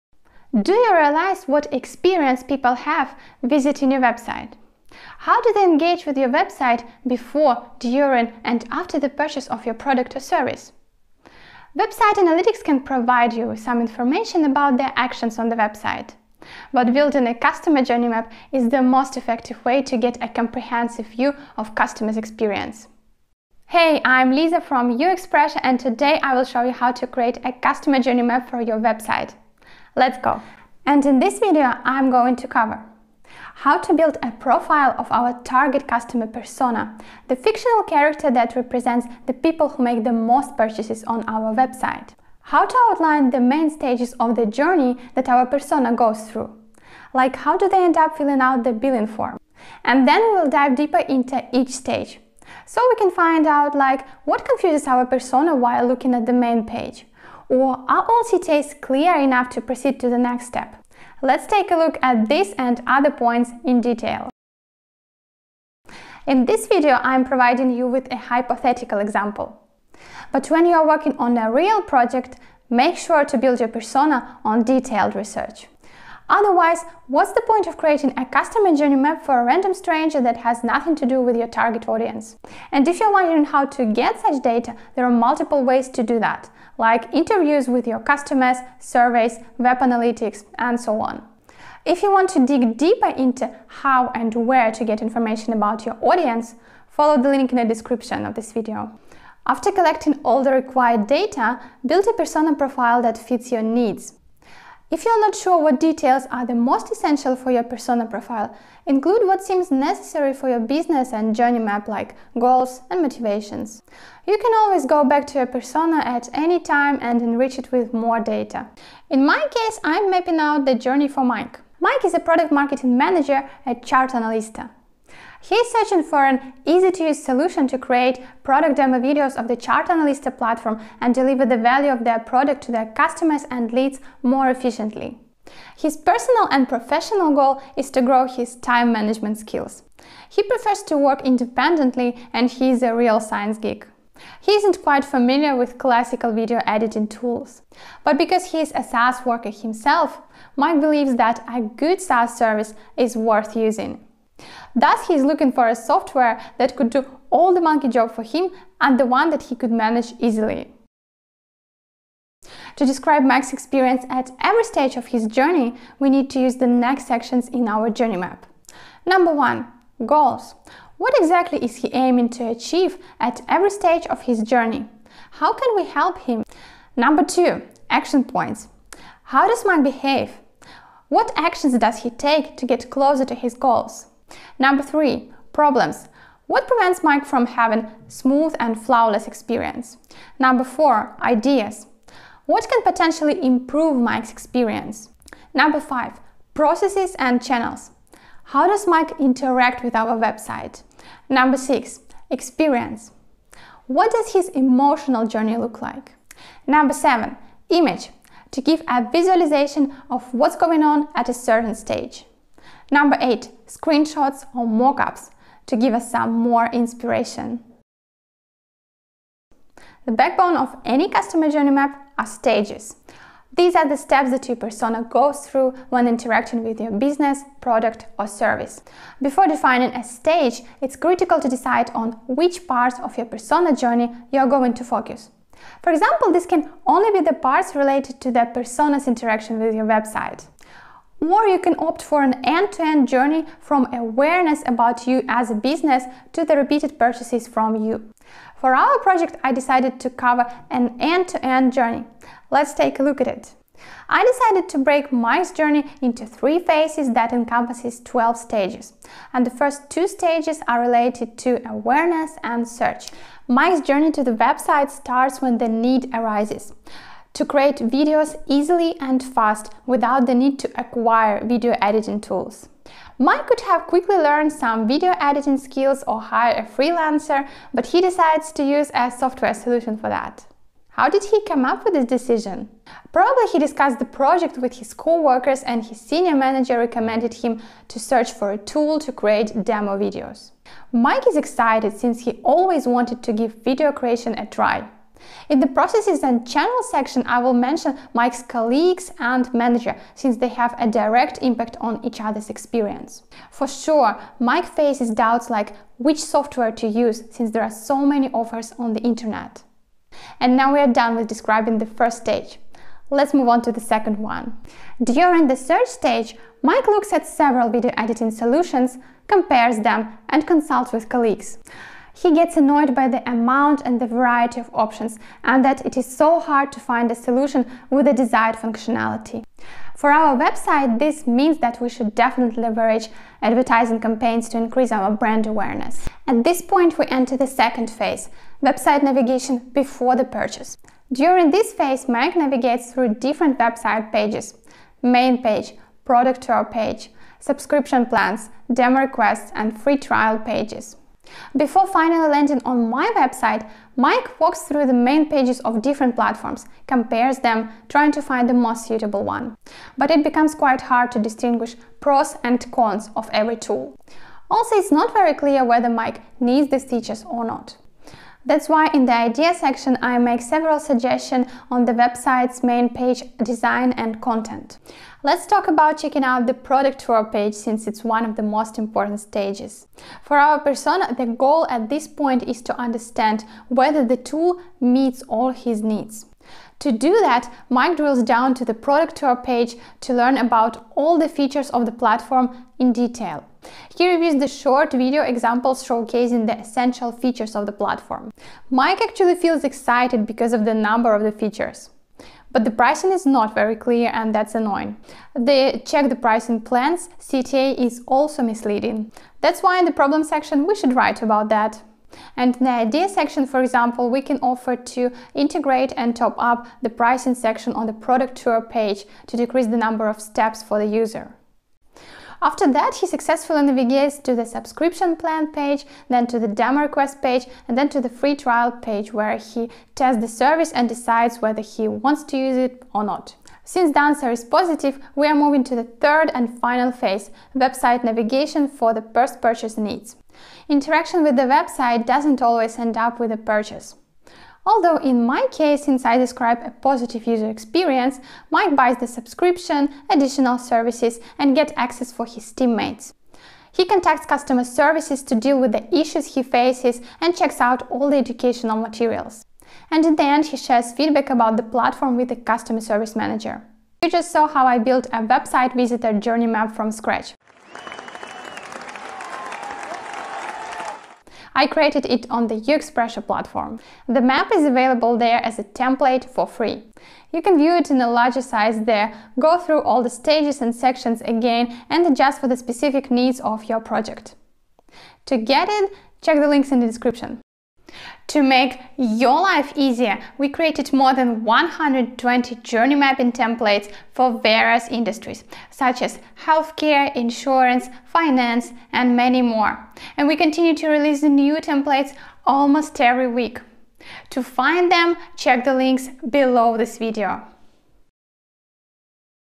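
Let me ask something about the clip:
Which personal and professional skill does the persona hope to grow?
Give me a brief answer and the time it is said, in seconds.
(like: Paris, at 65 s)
Time management skills, at 138 s.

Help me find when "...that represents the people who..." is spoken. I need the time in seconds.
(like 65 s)
38 s.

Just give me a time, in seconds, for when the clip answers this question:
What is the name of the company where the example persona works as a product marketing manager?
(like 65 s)
123 s.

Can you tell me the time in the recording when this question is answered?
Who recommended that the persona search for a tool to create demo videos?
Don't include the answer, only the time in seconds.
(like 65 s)
285 s.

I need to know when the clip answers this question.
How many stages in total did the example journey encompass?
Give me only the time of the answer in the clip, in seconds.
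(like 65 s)
258 s.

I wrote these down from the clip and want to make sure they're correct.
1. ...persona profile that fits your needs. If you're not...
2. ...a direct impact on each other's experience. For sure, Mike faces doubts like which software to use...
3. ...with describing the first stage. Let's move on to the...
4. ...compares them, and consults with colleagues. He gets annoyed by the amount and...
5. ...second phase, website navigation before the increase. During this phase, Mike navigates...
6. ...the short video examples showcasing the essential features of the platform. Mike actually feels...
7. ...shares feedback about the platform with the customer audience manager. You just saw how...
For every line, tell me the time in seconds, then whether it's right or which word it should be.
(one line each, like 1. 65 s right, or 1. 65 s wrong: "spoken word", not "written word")
1. 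102 s right
2. 300 s right
3. 311 s right
4. 319 s right
5. 337 s wrong: "purchase", not "increase"
6. 394 s right
7. 460 s wrong: "service", not "audience".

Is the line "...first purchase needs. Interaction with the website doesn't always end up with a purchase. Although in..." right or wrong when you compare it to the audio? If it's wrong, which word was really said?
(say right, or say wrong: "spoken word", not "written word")
right.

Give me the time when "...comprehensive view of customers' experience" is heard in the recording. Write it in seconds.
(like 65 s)
20 s.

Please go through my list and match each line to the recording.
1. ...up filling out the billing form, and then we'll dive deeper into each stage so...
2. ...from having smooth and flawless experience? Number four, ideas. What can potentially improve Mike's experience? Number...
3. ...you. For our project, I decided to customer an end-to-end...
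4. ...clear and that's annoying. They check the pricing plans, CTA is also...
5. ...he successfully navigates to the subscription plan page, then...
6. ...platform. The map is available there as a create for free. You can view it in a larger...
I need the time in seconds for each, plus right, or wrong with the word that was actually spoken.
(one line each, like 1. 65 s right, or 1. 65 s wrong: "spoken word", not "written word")
1. 47 s right
2. 187 s right
3. 247 s wrong: "cover", not "customer"
4. 403 s right
5. 422 s right
6. 473 s wrong: "template", not "create".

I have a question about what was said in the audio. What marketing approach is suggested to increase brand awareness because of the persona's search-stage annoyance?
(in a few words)
Advertising campaigns.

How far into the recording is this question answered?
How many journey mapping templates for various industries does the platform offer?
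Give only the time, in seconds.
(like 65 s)
490 s.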